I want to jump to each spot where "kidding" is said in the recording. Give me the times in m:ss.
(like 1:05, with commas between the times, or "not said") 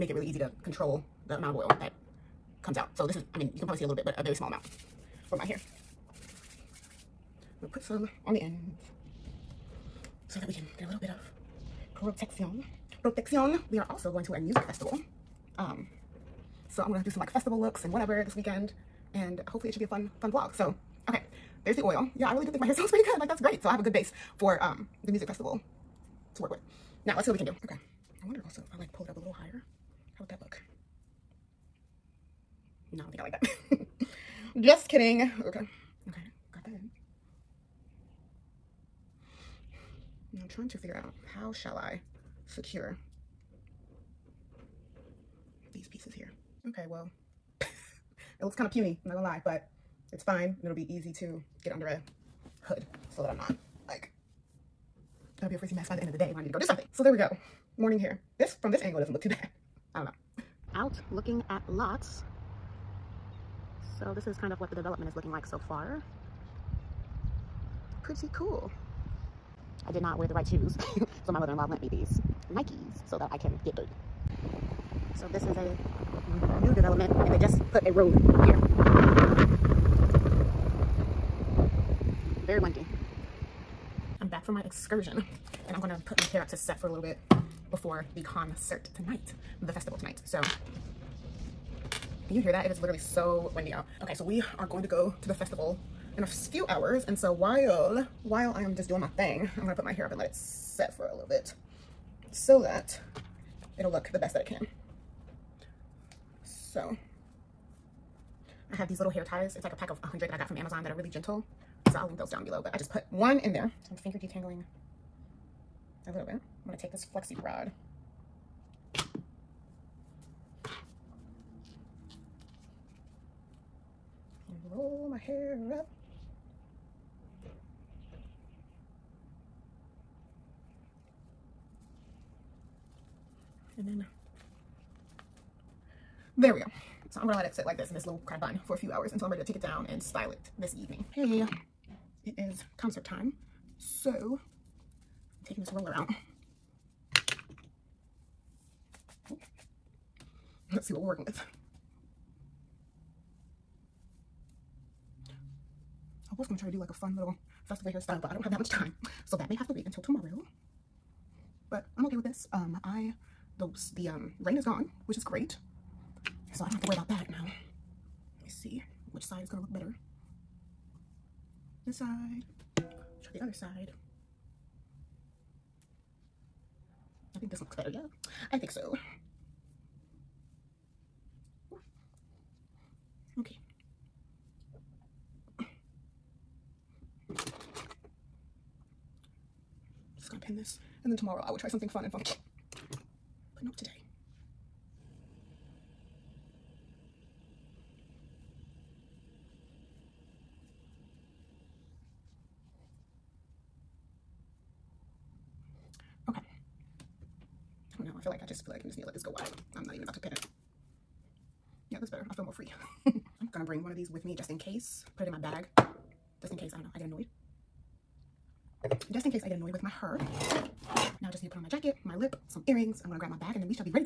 0:34.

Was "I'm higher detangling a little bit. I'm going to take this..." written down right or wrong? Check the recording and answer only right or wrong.
wrong.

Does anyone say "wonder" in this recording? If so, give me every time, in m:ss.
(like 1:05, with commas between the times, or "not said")
0:28.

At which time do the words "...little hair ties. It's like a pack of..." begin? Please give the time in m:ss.
1:48.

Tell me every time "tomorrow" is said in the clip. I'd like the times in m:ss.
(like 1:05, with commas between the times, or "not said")
2:40, 3:11.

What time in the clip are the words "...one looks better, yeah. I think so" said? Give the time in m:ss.
2:57.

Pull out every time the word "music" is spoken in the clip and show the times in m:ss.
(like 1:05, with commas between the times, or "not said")
0:14, 0:25.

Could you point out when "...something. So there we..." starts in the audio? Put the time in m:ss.
0:56.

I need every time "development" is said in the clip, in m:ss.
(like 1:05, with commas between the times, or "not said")
1:04, 1:16.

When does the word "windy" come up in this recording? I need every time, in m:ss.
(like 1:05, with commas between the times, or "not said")
1:22, 1:33.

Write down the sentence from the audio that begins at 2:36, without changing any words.
I was gonna try to do like a fun little festival hairstyle, but I don't have that much time.